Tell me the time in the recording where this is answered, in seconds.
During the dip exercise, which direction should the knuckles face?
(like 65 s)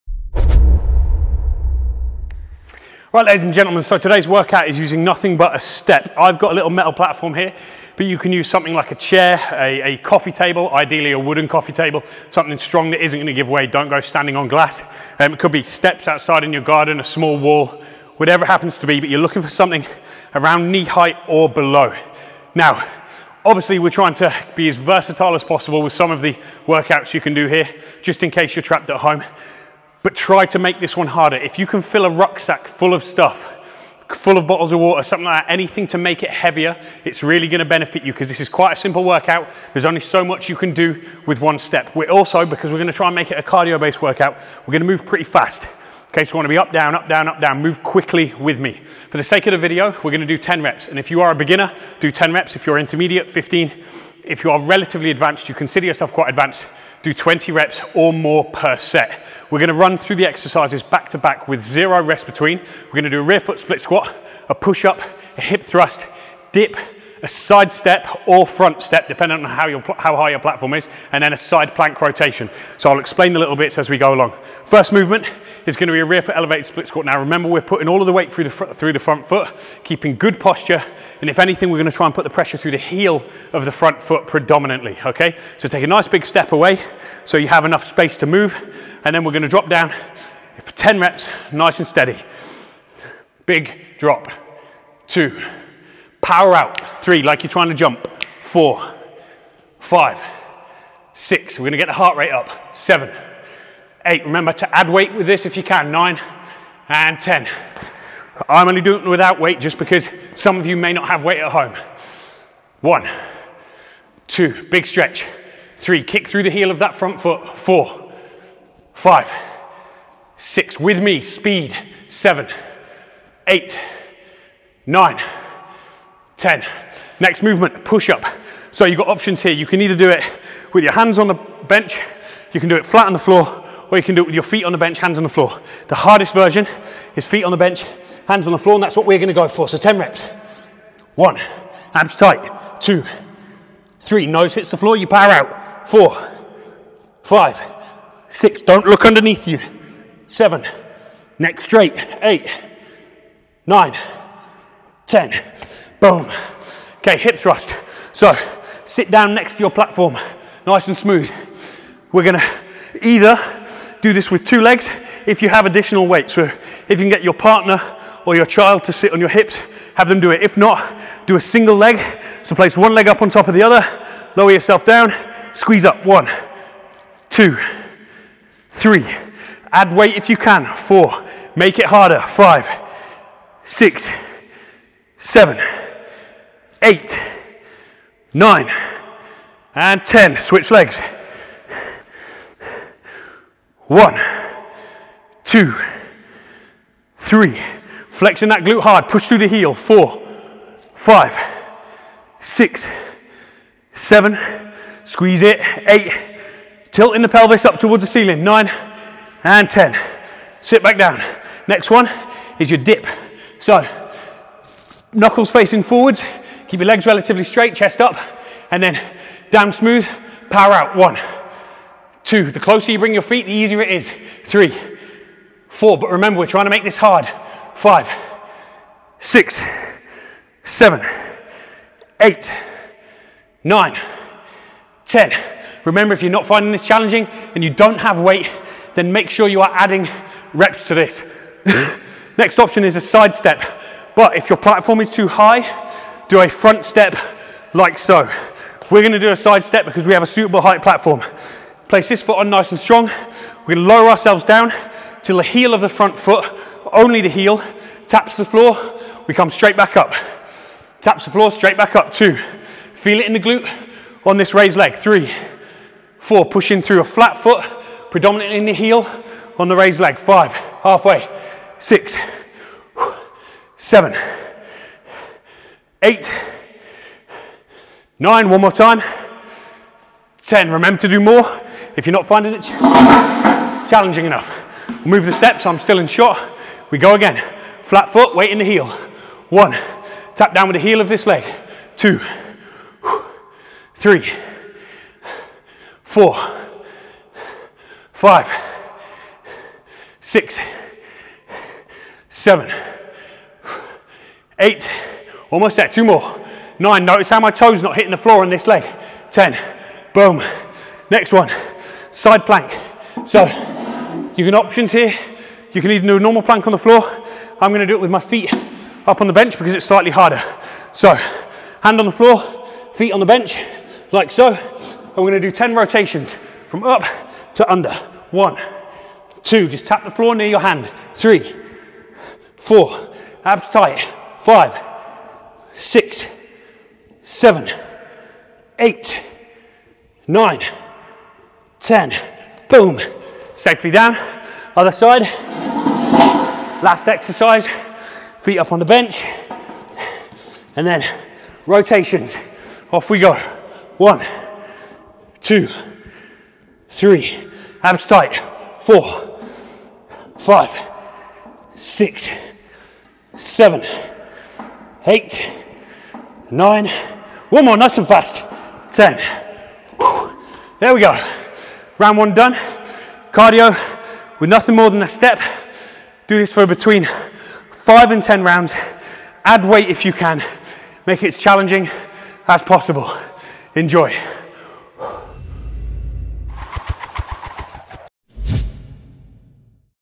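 215 s.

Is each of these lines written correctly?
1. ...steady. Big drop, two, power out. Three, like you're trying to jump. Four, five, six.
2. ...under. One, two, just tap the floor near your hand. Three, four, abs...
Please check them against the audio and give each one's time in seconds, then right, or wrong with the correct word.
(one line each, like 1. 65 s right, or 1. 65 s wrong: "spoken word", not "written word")
1. 91 s right
2. 327 s right.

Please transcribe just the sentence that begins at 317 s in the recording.
I'm gonna do it with my feet up on the bench because it's slightly harder.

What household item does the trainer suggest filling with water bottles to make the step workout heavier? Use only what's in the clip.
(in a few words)
rucksack.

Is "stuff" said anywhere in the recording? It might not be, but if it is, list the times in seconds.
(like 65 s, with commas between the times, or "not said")
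33 s.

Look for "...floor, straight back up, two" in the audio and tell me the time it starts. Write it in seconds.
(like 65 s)
261 s.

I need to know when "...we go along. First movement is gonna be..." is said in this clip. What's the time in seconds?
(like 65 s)
73 s.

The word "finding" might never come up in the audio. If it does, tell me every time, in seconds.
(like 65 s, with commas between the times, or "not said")
236 s, 282 s.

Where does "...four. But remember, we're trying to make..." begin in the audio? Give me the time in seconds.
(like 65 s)
225 s.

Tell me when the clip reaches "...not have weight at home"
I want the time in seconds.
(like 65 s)
110 s.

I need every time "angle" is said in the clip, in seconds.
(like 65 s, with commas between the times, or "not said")
not said.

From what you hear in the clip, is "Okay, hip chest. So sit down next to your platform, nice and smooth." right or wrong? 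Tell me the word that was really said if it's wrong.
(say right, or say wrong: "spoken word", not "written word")
wrong: "thrust", not "chest".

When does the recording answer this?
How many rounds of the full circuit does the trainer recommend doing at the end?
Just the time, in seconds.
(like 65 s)
376 s.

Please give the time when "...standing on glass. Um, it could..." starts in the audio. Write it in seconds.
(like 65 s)
13 s.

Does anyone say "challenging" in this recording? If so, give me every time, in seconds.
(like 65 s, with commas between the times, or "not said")
236 s, 282 s, 381 s.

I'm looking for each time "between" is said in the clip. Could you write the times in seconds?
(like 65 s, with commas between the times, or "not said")
62 s, 376 s.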